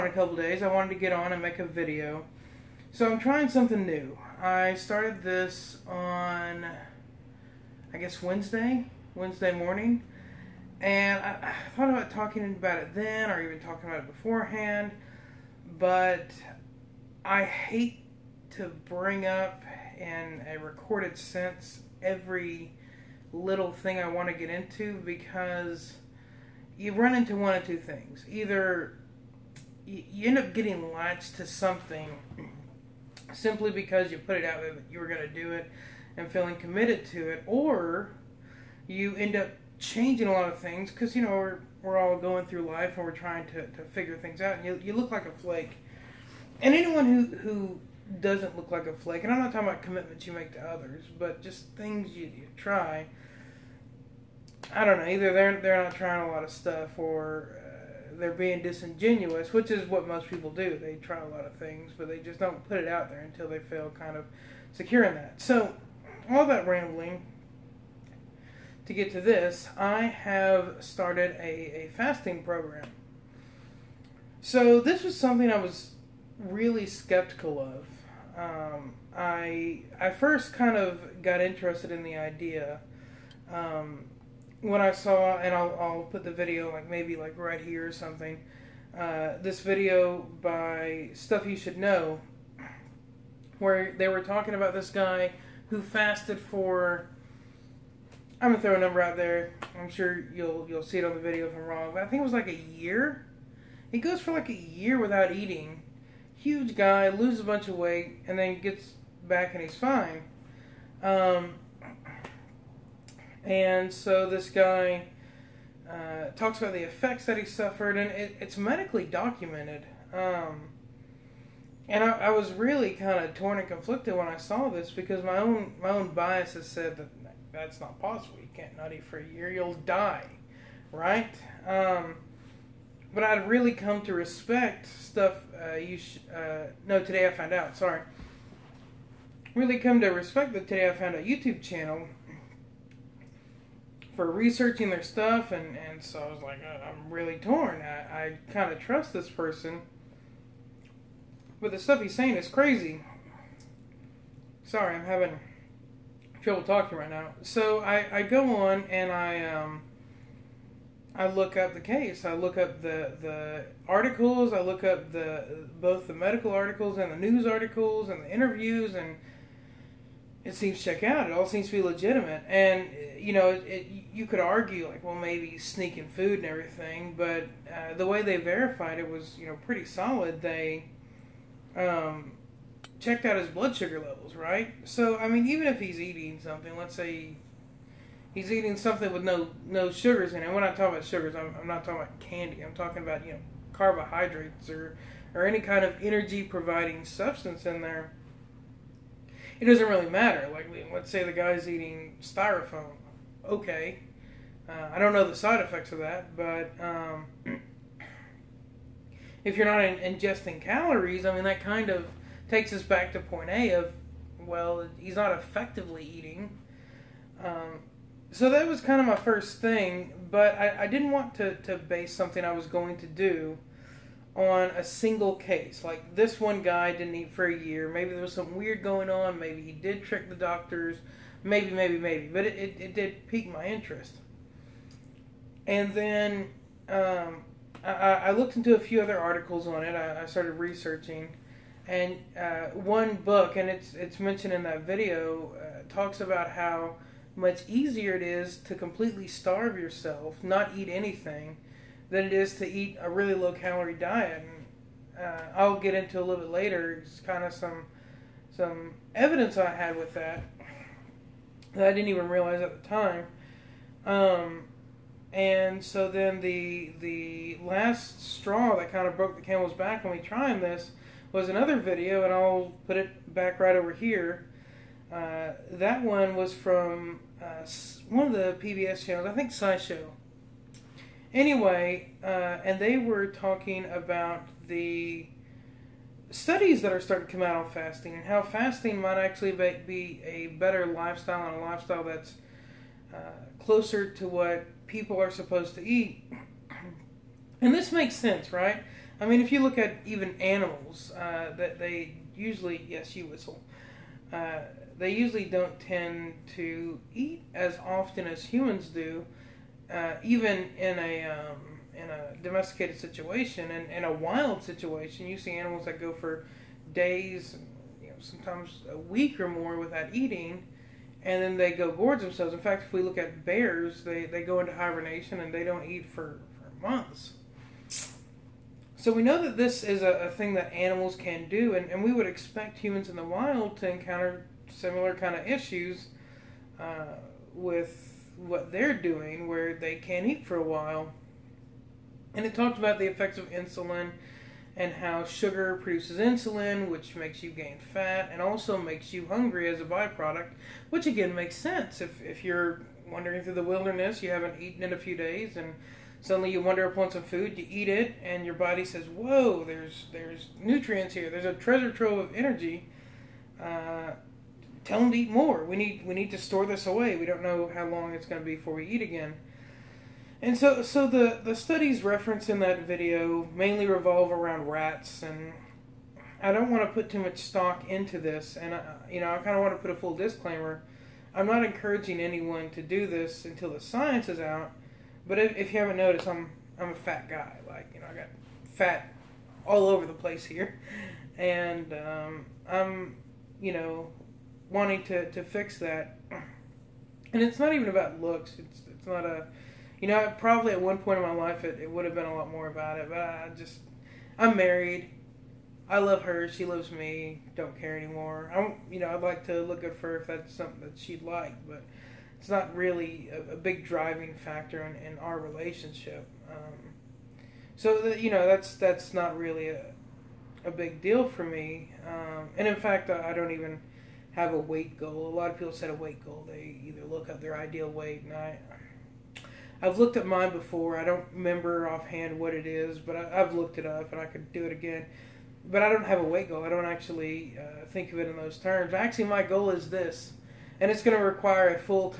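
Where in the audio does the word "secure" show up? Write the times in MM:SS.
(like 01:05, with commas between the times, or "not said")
01:04.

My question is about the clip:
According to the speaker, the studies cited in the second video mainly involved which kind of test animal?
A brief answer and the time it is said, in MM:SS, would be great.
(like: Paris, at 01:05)
rats, at 06:14.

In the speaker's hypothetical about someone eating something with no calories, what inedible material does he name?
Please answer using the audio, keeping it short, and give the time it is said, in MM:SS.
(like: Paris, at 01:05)
styrofoam, at 03:22.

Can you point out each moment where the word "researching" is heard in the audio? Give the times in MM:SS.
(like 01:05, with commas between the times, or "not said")
02:24, 04:00.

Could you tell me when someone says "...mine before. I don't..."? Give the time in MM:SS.
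07:10.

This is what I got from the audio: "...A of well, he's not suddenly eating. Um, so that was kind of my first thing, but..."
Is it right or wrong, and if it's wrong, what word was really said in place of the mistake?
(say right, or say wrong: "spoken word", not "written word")
wrong: "effectively", not "suddenly".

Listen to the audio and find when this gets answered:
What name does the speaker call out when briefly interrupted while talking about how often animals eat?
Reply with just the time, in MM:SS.
05:03.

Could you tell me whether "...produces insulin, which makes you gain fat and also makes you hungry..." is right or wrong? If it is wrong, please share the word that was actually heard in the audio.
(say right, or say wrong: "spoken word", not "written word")
right.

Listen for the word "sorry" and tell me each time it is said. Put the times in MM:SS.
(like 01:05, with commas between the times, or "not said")
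02:17, 02:34.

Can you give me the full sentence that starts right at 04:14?
And, uh, I'll get into a little bit later.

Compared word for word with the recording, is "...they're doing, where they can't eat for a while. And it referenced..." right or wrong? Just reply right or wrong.
wrong.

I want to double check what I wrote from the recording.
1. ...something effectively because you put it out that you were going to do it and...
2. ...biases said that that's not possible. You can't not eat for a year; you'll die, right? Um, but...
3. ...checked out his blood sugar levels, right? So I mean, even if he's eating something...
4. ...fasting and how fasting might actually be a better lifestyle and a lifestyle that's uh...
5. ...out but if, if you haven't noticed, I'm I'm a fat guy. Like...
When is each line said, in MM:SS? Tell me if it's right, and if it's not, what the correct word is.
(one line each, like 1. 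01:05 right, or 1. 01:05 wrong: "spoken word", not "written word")
1. 00:31 wrong: "simply", not "effectively"
2. 02:06 right
3. 03:02 right
4. 04:47 right
5. 06:24 right.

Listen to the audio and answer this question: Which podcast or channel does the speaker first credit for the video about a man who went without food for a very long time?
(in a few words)
Stuff You Should Know.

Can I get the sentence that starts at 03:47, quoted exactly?
Maybe there was something weird going on.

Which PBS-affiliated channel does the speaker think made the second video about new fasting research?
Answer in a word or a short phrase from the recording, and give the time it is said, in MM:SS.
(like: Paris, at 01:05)
SciShow, at 04:39.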